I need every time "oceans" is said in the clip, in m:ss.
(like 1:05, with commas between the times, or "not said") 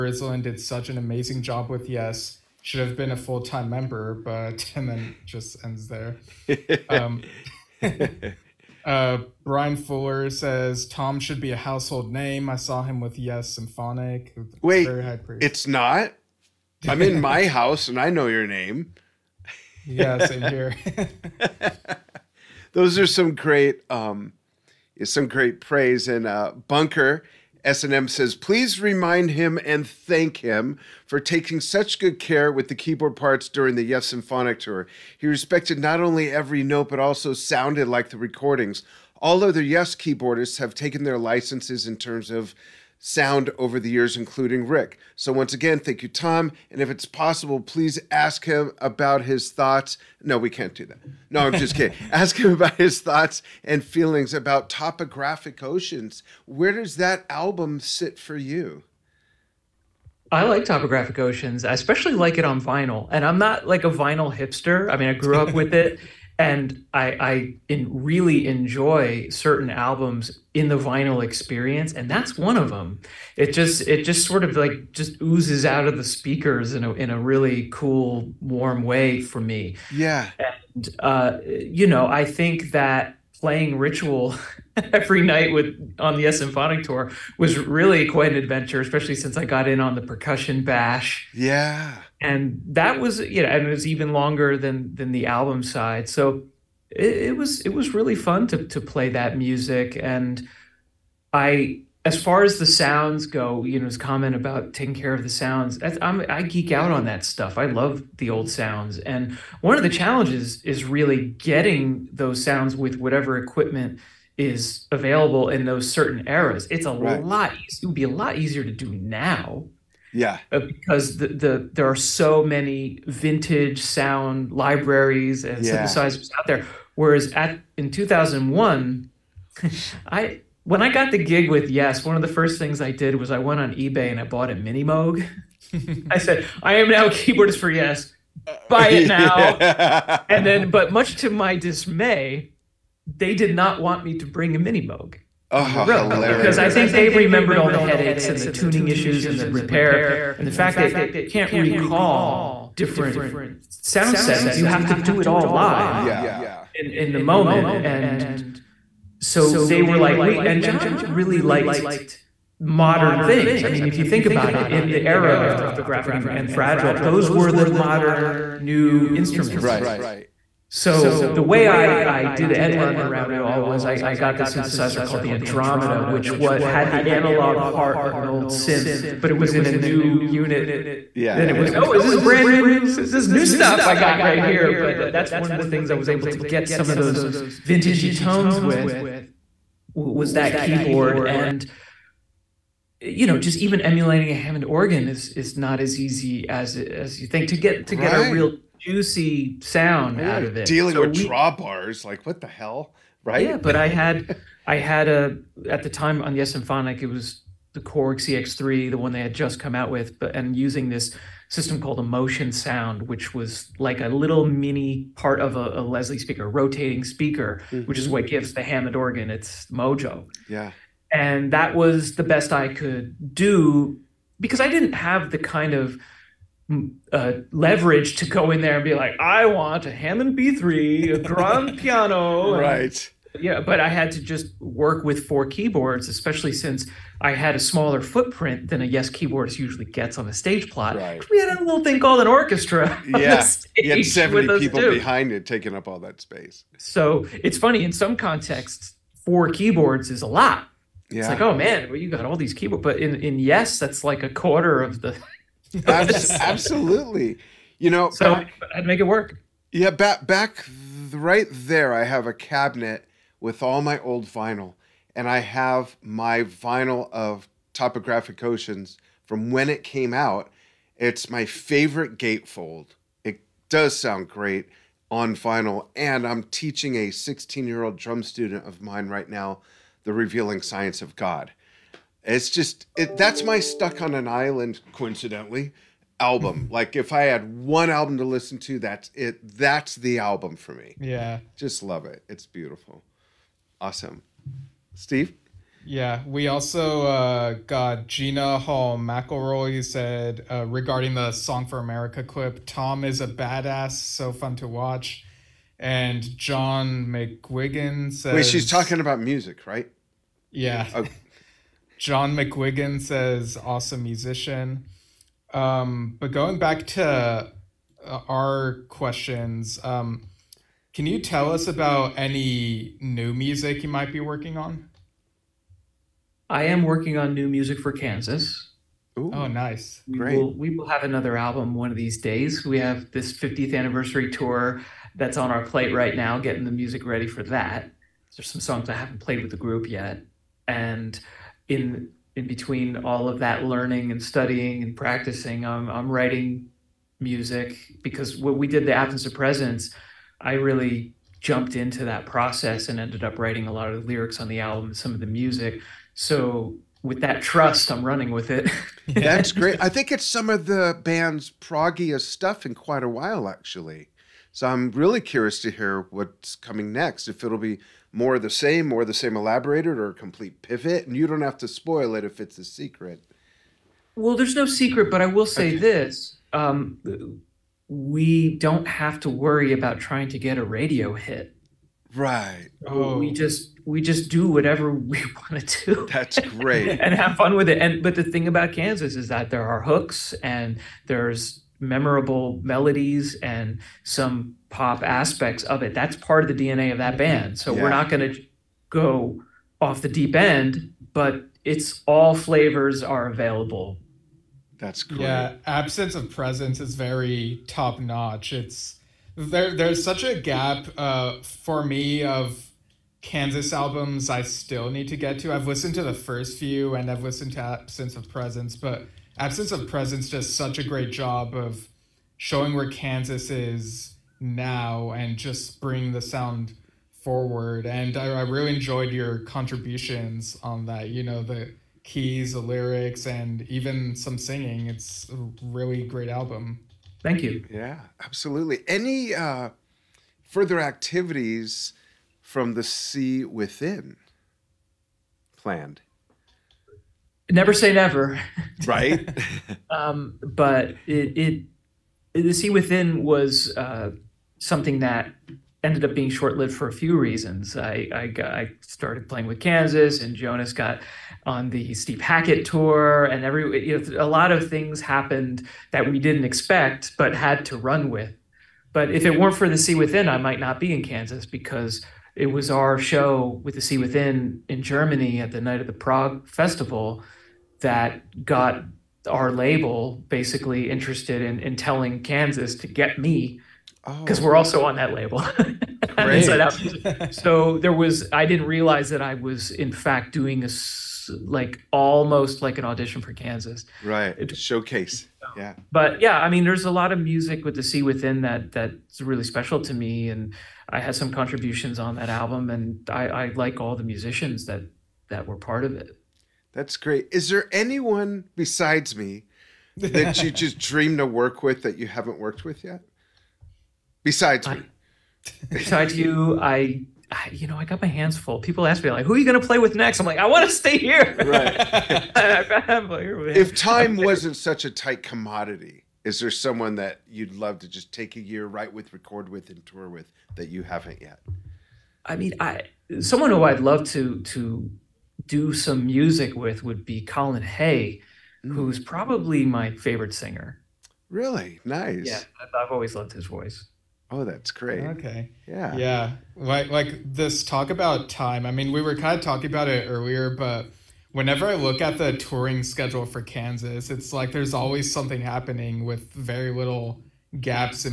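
0:55, 1:01, 4:28.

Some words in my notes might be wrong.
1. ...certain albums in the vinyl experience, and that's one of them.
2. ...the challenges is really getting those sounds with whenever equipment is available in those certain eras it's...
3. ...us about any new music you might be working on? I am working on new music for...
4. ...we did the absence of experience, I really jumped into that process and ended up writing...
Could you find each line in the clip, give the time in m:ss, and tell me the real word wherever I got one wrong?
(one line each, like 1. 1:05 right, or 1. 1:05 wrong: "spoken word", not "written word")
1. 1:09 right
2. 1:49 wrong: "whatever", not "whenever"
3. 5:21 right
4. 5:48 wrong: "presence", not "experience".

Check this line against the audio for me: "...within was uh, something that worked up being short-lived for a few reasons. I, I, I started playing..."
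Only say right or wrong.
wrong.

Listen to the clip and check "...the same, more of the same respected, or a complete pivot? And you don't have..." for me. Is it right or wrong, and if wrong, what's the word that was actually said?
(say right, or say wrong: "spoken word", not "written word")
wrong: "elaborated", not "respected".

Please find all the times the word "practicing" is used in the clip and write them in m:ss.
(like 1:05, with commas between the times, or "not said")
5:44.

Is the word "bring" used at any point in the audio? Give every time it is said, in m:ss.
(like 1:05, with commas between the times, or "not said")
2:24, 7:05.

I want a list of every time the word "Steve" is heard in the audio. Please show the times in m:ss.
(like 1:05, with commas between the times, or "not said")
4:54, 7:41.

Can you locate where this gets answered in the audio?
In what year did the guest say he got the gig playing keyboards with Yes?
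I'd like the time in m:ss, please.
2:07.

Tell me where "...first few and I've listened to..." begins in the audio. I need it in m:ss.
6:56.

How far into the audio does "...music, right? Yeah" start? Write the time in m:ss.
5:09.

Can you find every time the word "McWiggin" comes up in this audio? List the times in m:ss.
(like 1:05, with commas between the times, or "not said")
5:12.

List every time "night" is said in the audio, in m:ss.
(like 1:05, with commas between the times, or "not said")
1:25, 7:55.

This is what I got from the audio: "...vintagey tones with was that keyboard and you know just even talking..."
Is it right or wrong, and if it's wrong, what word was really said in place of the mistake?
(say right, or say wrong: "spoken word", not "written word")
wrong: "emulating", not "talking".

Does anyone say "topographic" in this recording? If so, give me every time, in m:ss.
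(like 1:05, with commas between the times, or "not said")
0:54, 1:00, 2:45, 4:27.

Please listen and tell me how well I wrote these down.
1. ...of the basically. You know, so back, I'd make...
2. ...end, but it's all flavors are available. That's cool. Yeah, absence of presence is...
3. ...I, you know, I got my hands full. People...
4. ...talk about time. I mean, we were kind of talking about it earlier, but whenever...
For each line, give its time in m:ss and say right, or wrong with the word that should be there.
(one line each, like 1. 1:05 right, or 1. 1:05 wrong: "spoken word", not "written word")
1. 4:14 wrong: "absolutely", not "basically"
2. 6:40 right
3. 8:37 right
4. 9:07 right.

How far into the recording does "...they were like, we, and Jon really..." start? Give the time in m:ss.
2:39.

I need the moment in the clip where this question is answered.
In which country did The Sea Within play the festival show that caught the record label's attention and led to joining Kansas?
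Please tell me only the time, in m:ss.
7:54.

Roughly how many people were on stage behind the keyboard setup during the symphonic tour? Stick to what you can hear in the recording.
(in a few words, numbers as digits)
70.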